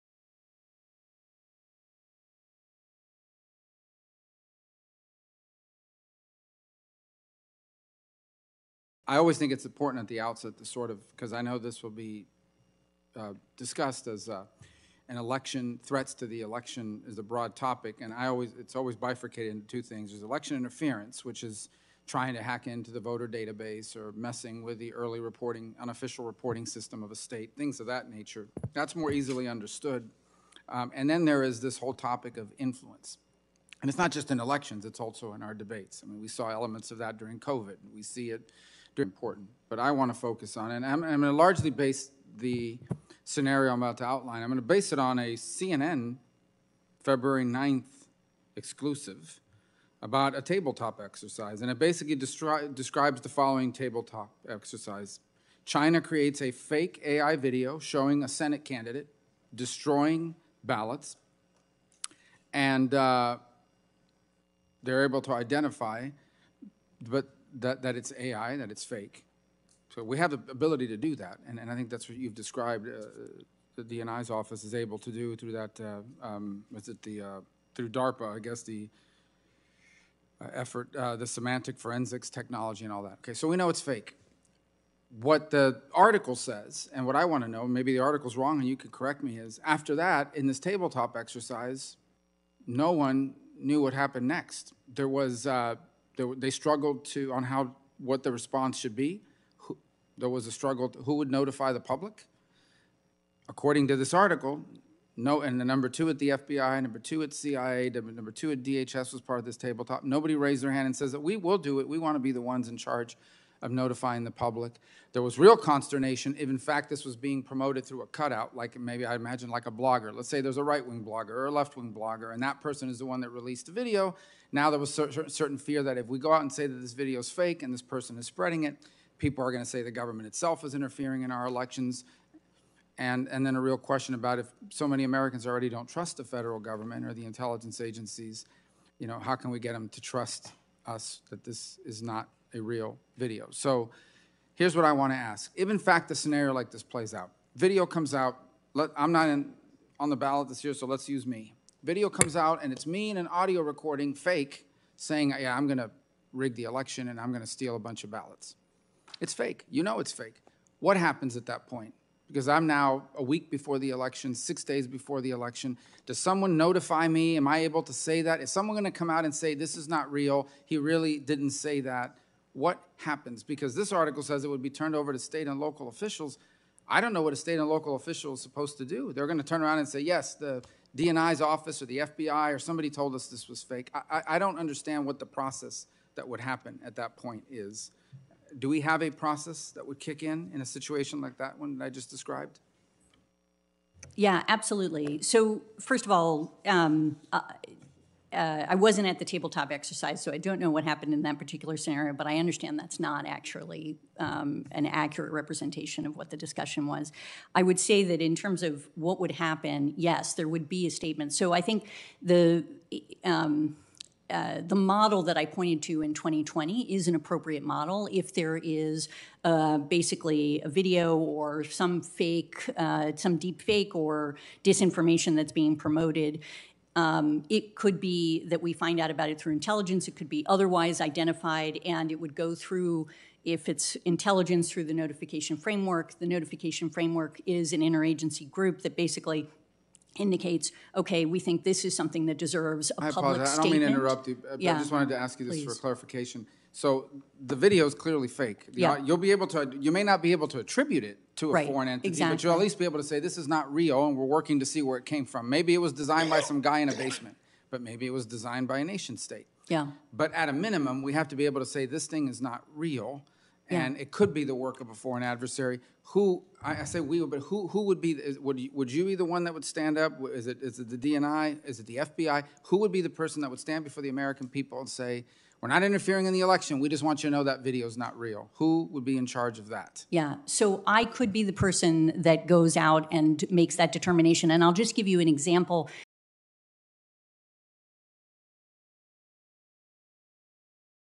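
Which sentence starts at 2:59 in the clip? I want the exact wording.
They're going to turn around and say, yes, the DNI's office or the FBI or somebody told us this was fake.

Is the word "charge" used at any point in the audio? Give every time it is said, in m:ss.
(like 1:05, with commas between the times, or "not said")
1:52, 4:39.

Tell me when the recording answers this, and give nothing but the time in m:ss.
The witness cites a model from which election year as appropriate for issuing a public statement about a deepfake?
3:36.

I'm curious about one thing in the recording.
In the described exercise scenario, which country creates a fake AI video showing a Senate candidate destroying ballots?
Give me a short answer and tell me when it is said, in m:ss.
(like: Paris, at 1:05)
China, at 0:55.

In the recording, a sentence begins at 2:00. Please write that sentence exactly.
Let's say there's a right wing blogger or a left wing blogger, and that person is the one that released the video.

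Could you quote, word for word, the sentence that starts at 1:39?
Who- There was a struggle, to- who would notify the public?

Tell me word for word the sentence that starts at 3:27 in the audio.
I would say that in terms of what would happen, yes, there would be a statement.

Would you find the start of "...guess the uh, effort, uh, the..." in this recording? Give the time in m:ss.
1:18.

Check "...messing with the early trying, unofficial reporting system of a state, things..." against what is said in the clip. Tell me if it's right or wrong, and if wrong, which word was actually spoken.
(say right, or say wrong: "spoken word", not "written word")
wrong: "reporting", not "trying".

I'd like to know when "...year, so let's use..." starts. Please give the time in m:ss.
2:30.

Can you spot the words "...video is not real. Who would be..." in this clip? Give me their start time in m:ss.
4:37.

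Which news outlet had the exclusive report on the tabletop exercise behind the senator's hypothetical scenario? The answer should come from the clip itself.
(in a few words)
CNN.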